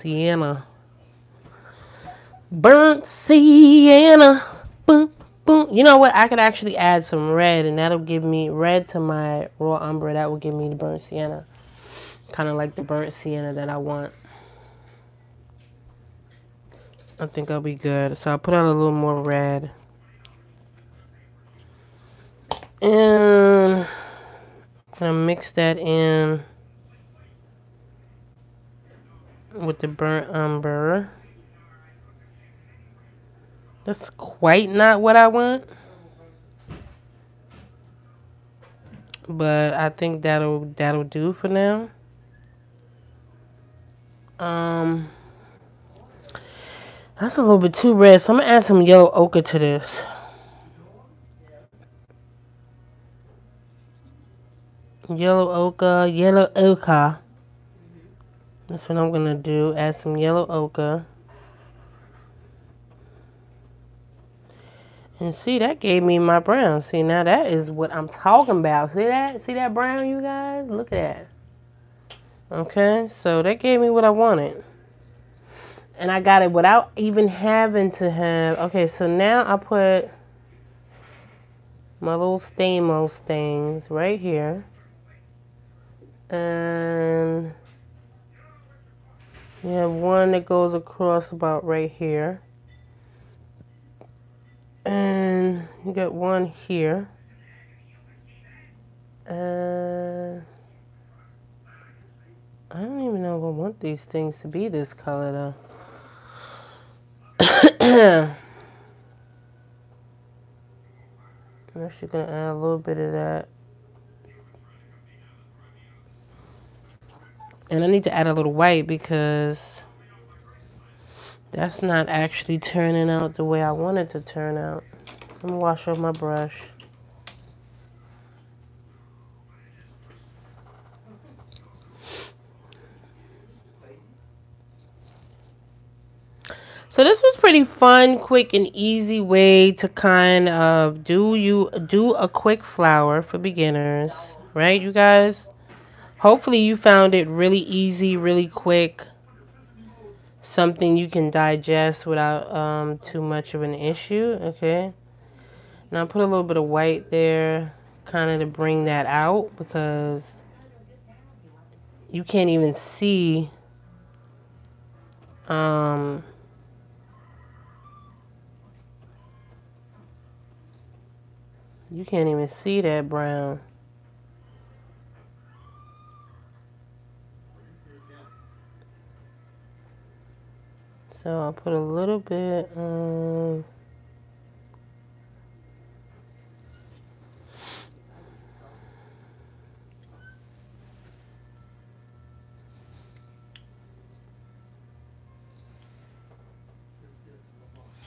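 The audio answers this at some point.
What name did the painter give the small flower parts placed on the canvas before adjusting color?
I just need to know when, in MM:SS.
01:22.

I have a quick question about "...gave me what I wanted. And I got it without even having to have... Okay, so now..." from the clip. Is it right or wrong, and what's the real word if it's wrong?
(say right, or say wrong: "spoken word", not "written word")
right.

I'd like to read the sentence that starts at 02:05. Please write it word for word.
I'm gonna wash off my brush.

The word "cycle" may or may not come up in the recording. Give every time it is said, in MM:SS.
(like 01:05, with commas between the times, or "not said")
not said.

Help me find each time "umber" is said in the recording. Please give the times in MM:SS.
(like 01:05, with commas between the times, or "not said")
00:09, 00:30.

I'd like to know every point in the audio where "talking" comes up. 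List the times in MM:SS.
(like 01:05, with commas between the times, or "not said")
01:08.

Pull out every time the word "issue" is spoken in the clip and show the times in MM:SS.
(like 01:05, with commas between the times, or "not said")
02:33.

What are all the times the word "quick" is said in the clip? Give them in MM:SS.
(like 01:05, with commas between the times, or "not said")
02:18, 02:22, 02:28.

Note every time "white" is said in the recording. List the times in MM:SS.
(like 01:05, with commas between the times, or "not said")
01:58, 02:36.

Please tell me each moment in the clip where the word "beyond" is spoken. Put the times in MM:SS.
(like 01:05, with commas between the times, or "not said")
not said.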